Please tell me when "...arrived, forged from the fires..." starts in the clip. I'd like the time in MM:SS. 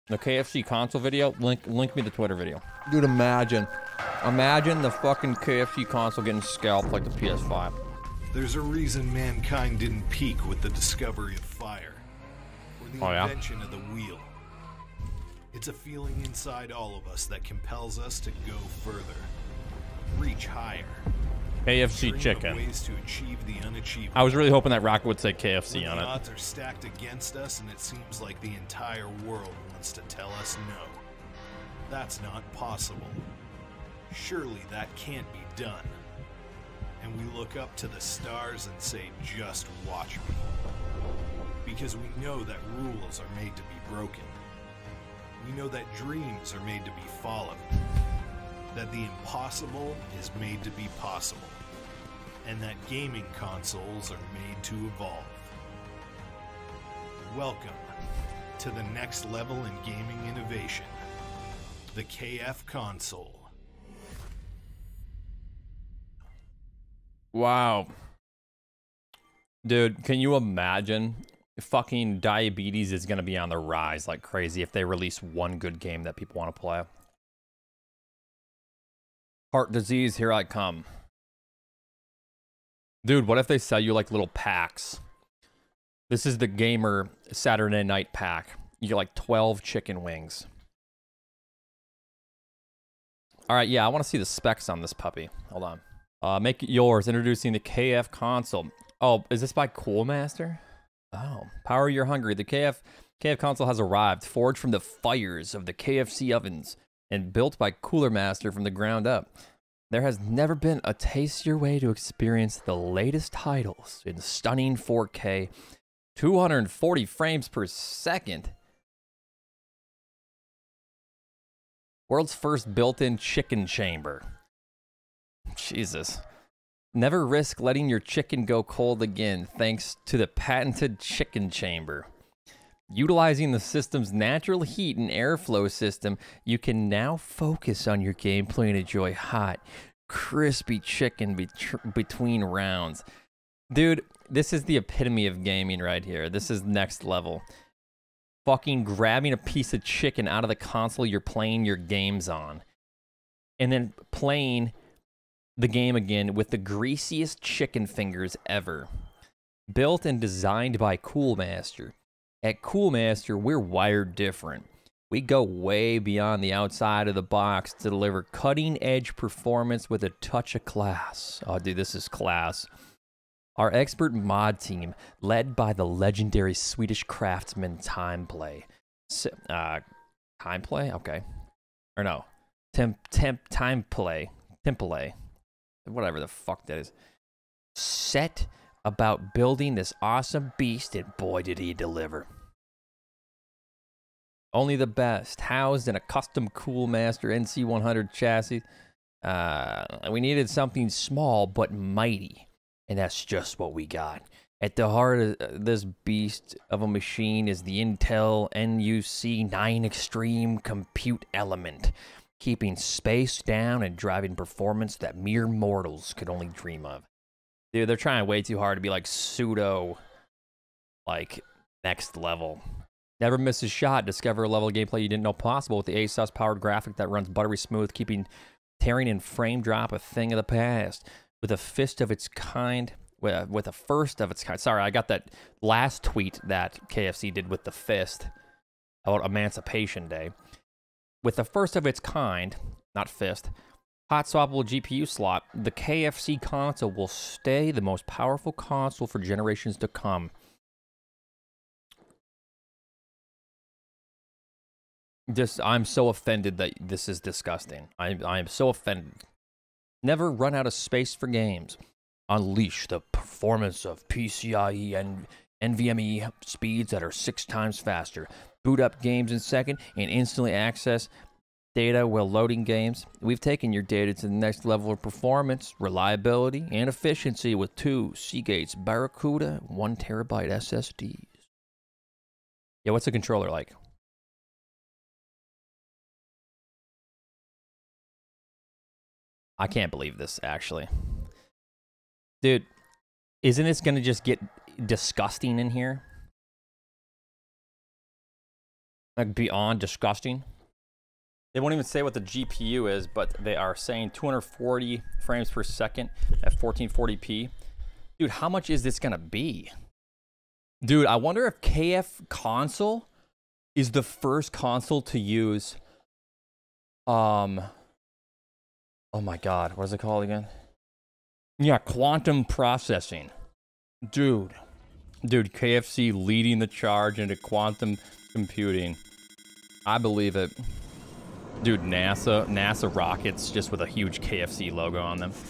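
01:43.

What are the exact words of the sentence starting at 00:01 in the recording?
Link link me the Twitter video.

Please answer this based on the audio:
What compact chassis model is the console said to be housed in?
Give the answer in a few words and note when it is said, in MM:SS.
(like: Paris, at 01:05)
NC100, at 03:17.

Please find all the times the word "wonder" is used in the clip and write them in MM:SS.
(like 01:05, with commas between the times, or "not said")
05:11.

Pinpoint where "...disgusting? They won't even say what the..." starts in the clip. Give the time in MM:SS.
04:59.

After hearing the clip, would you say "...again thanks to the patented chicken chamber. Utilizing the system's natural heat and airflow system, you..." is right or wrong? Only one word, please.
right.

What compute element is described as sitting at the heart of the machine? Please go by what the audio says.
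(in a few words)
Intel NUC 9 Extreme.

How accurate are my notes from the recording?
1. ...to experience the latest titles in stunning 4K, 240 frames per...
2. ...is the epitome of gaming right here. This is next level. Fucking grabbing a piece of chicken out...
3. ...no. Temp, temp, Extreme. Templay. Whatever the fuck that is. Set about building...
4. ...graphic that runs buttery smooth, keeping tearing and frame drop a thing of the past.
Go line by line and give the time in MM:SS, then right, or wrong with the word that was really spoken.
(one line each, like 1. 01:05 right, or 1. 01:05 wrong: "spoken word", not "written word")
1. 01:51 right
2. 02:24 right
3. 03:02 wrong: "Timeplay", not "Extreme"
4. 03:46 right.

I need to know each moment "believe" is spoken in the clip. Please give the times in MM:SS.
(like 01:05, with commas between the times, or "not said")
04:49, 05:29.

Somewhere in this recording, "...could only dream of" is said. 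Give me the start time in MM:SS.
03:36.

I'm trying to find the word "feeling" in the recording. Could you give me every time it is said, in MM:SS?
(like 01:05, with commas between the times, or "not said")
00:15.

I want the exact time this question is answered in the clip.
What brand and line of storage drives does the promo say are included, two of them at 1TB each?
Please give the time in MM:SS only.
04:38.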